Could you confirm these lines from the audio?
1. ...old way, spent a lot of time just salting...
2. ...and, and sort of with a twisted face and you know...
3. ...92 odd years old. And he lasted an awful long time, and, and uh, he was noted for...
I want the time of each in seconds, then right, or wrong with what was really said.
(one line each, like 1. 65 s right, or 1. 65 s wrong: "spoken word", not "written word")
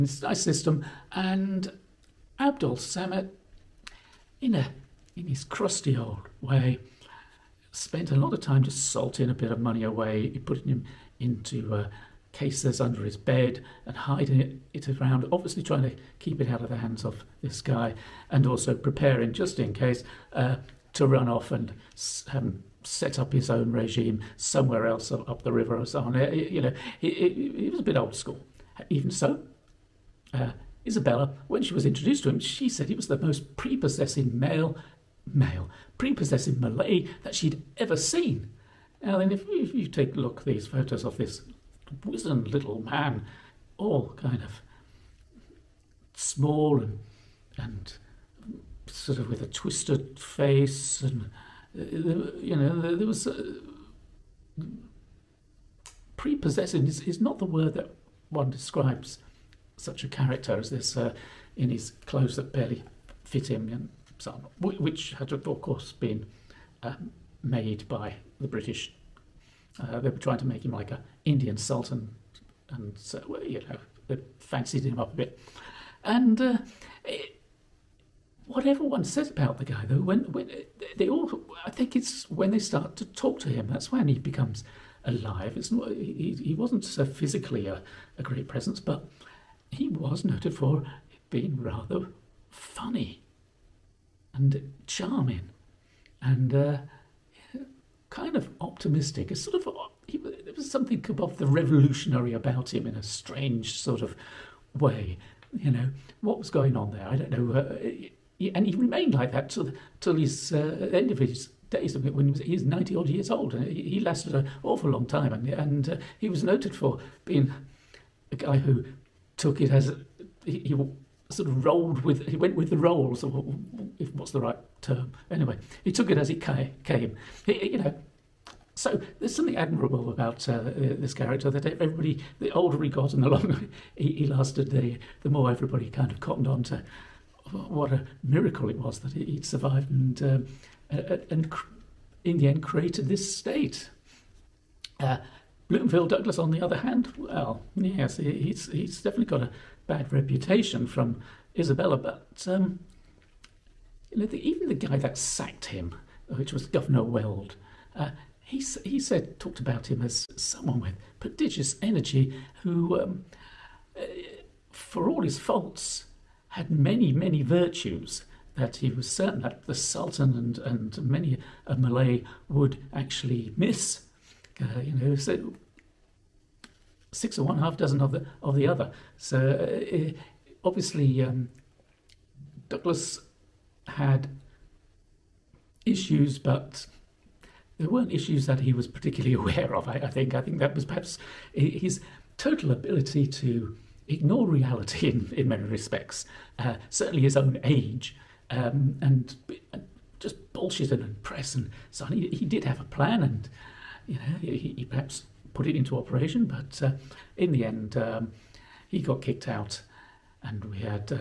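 1. 5 s right
2. 46 s right
3. 112 s wrong: "90", not "92".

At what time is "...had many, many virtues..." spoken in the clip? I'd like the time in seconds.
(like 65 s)
166 s.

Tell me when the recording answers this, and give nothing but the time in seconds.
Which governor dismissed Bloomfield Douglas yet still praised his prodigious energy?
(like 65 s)
156 s.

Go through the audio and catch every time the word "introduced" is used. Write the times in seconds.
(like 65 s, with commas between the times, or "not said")
31 s.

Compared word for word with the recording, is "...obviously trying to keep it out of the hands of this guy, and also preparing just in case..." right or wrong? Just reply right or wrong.
right.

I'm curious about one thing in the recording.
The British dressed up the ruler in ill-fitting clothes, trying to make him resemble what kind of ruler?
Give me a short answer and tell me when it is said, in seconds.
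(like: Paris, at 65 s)
An Indian sultan, at 71 s.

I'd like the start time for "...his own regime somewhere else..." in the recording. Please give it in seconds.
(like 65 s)
23 s.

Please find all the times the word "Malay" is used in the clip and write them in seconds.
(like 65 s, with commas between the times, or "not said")
36 s, 171 s.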